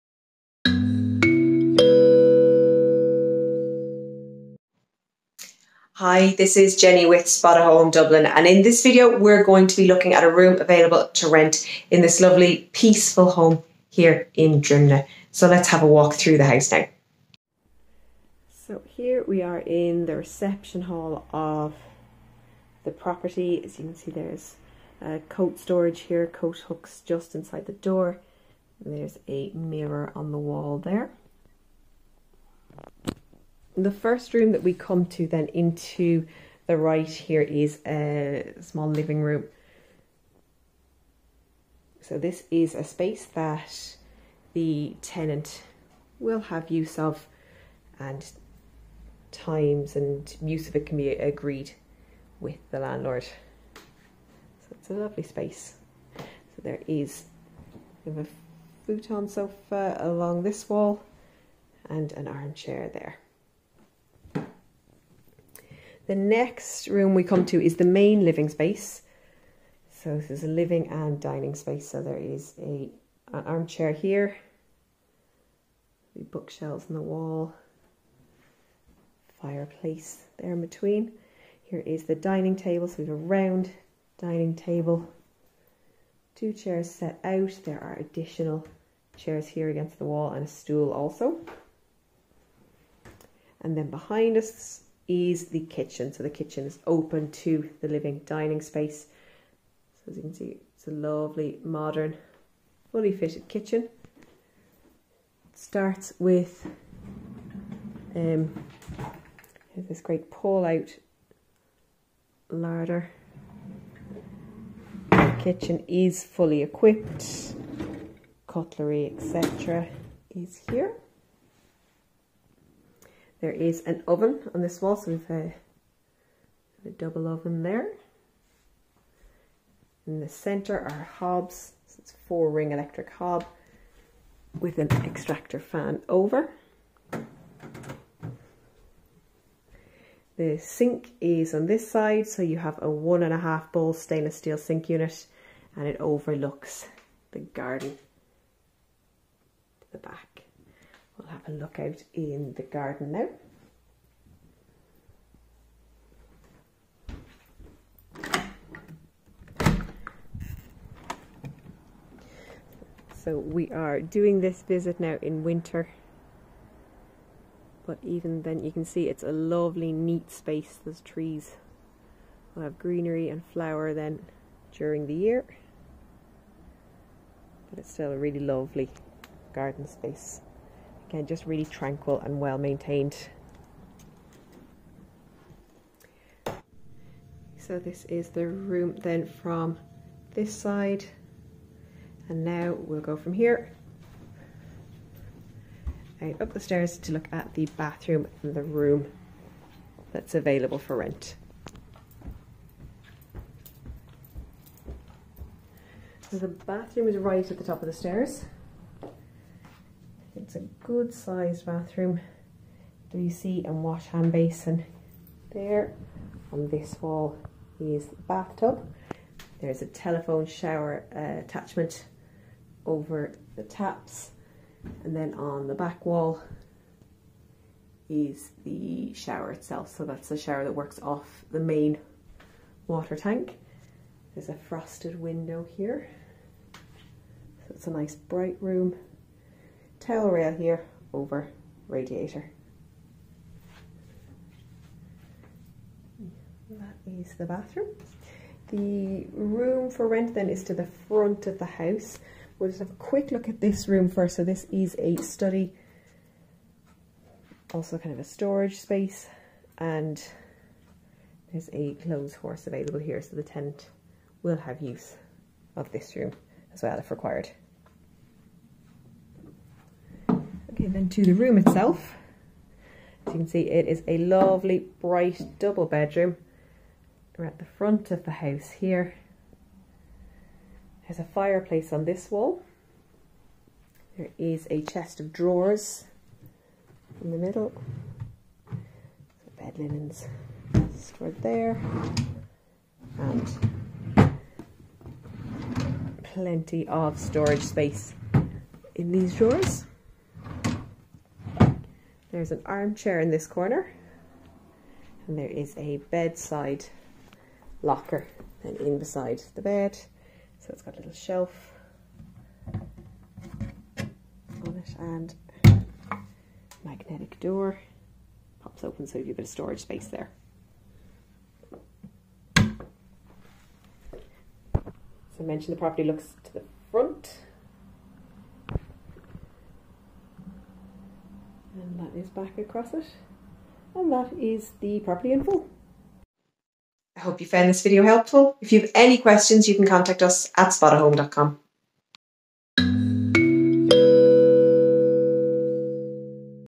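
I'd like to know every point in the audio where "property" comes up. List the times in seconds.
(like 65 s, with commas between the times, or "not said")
22 s, 325 s, 335 s.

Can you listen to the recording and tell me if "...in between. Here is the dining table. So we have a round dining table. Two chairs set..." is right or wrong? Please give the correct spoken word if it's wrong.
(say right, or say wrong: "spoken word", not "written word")
right.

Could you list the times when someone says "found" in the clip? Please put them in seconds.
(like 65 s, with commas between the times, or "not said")
337 s.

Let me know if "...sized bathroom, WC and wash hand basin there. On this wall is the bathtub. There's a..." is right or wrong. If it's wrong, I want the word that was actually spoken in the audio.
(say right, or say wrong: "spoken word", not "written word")
right.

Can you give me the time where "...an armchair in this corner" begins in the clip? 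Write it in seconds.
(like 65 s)
302 s.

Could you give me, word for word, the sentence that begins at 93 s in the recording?
And then behind us is the kitchen.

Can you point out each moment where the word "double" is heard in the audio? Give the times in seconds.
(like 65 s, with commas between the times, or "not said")
126 s, 275 s.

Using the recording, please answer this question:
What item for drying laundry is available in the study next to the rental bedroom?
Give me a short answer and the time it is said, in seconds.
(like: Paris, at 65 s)
Clothes horse, at 261 s.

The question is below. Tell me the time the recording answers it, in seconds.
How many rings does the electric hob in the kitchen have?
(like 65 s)
132 s.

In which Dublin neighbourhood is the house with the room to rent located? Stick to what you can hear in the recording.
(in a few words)
Drimnagh.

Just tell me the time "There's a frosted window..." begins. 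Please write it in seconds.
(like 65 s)
234 s.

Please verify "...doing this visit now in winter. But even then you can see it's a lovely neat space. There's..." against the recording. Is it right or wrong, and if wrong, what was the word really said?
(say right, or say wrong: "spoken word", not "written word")
right.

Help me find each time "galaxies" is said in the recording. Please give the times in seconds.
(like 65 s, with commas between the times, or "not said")
not said.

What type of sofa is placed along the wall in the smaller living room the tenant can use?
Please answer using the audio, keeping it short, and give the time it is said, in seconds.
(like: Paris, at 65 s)
Futon sofa, at 58 s.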